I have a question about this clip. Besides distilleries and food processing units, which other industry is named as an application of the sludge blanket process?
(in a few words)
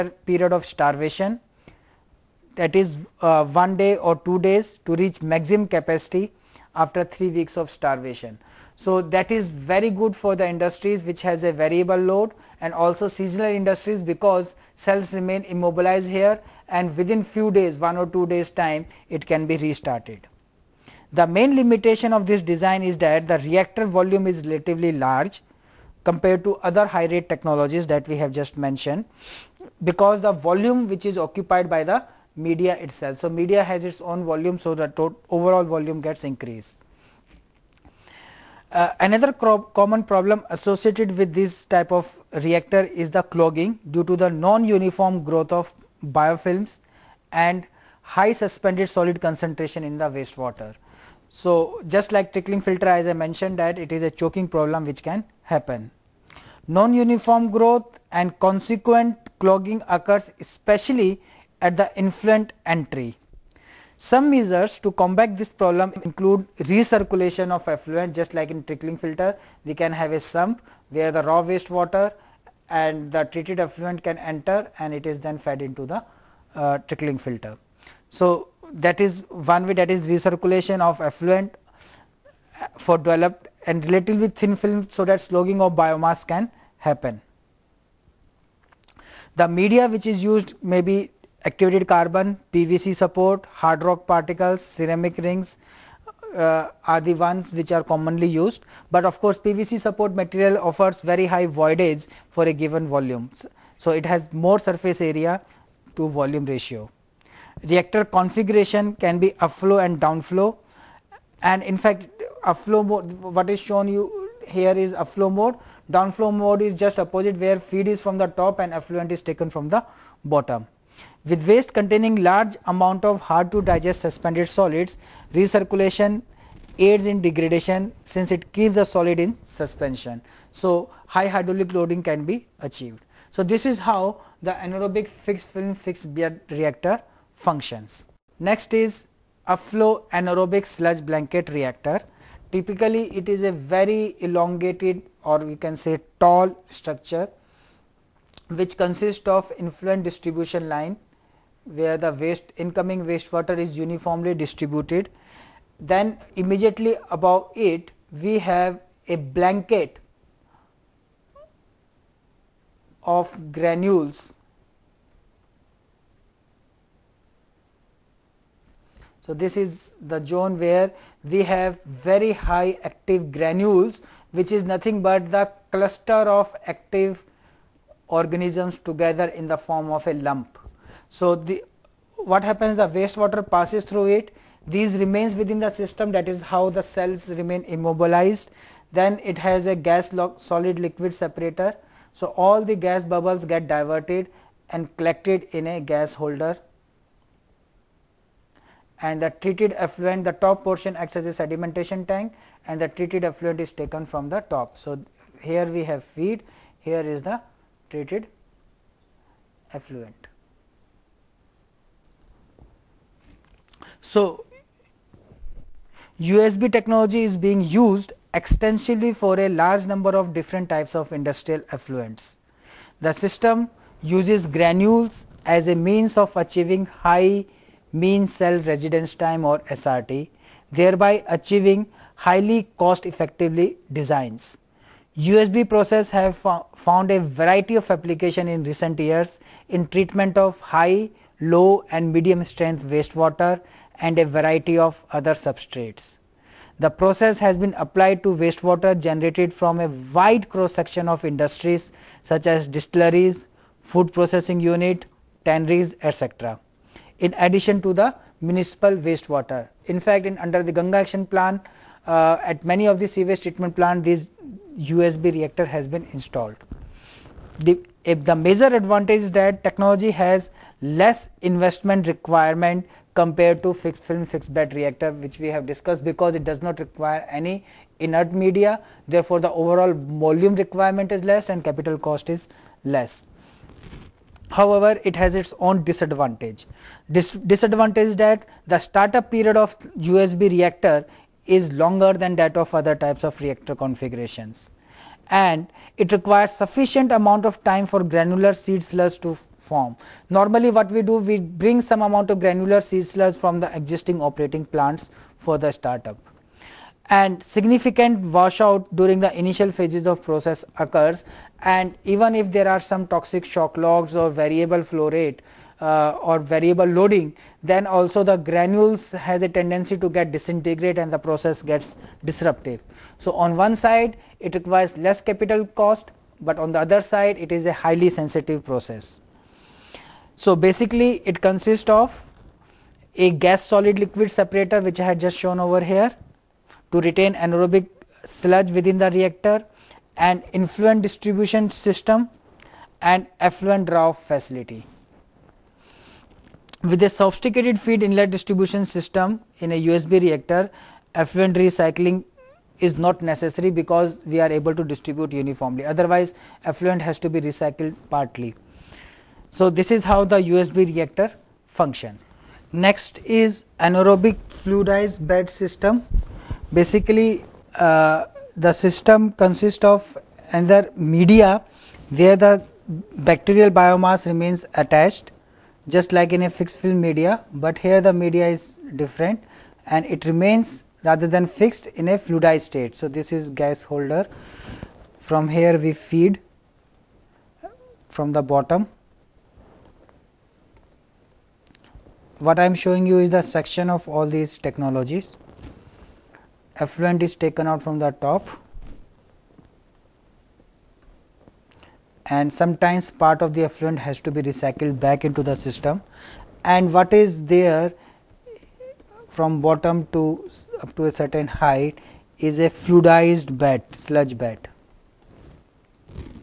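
tanneries.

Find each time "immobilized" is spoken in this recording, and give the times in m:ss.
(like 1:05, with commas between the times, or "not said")
0:15, 3:07.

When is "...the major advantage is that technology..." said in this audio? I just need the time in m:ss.
4:28.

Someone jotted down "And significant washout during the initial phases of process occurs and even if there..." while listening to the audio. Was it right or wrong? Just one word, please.
right.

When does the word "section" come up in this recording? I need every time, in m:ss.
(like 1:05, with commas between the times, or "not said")
4:10, 6:33.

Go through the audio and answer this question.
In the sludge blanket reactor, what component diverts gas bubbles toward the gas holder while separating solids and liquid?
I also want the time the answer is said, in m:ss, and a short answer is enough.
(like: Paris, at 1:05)
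gas lock, at 3:09.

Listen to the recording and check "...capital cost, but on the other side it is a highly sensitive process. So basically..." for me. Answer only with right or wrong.
right.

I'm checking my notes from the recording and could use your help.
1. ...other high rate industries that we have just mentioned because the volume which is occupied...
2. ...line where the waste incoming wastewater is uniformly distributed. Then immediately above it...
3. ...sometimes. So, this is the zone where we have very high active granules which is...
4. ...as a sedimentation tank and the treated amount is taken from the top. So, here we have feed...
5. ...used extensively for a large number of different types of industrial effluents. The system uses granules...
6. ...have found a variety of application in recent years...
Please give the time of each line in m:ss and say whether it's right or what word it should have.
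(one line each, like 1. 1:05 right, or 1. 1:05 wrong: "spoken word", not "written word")
1. 0:26 wrong: "technologies", not "industries"
2. 2:30 right
3. 2:43 wrong: "granules", not "sometimes"
4. 3:21 wrong: "effluent", not "amount"
5. 3:37 right
6. 3:56 right.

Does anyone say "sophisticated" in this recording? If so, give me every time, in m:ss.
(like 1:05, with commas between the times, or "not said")
5:47.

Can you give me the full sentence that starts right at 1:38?
But of course, PVC support material offers very high voidage for a given volume.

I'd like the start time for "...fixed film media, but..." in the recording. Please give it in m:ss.
6:16.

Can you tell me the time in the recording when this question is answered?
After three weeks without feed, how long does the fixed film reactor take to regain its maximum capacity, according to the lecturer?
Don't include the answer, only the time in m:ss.
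0:03.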